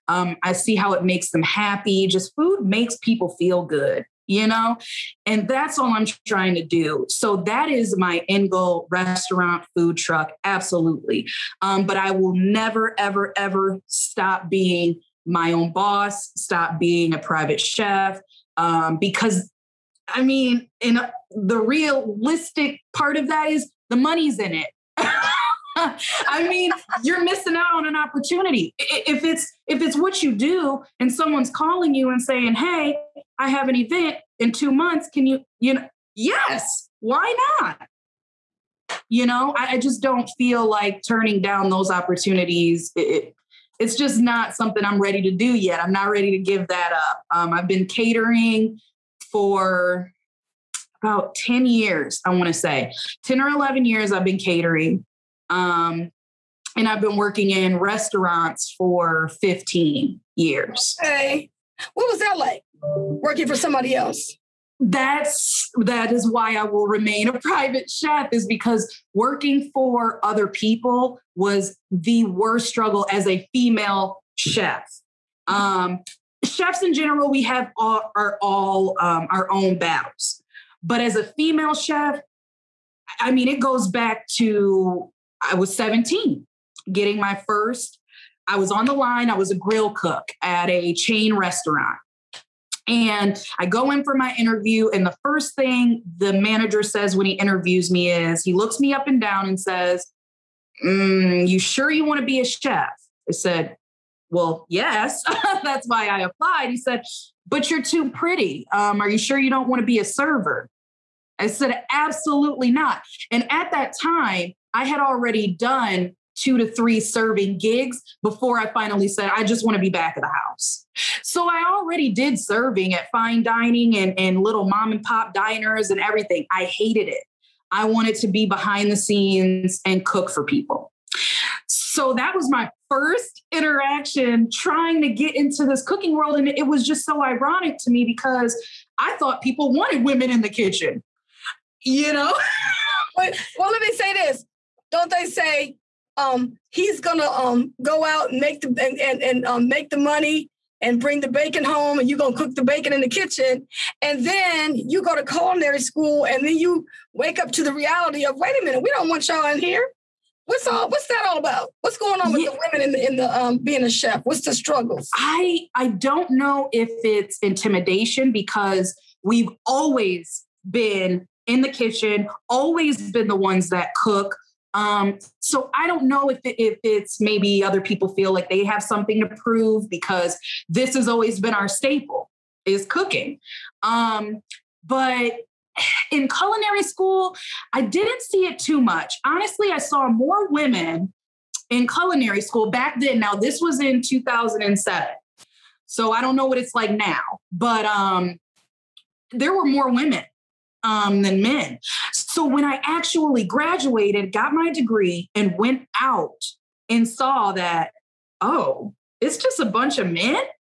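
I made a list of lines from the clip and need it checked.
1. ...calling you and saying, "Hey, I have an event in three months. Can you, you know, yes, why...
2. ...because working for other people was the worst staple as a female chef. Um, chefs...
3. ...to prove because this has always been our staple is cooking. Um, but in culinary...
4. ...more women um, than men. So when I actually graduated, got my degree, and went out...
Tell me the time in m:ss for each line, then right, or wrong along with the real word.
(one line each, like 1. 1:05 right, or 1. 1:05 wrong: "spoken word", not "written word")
1. 0:31 wrong: "two", not "three"
2. 1:08 wrong: "struggle", not "staple"
3. 2:59 right
4. 3:19 right.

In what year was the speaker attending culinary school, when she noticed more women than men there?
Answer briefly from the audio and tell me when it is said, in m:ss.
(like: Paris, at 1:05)
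2007, at 3:14.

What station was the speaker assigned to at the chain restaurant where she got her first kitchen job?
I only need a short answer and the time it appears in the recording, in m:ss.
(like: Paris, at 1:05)
grill cook, at 1:29.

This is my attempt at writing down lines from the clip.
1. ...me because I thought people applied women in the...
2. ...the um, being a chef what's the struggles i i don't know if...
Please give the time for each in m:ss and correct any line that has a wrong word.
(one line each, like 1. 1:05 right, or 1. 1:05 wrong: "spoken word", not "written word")
1. 2:17 wrong: "wanted", not "applied"
2. 2:43 right.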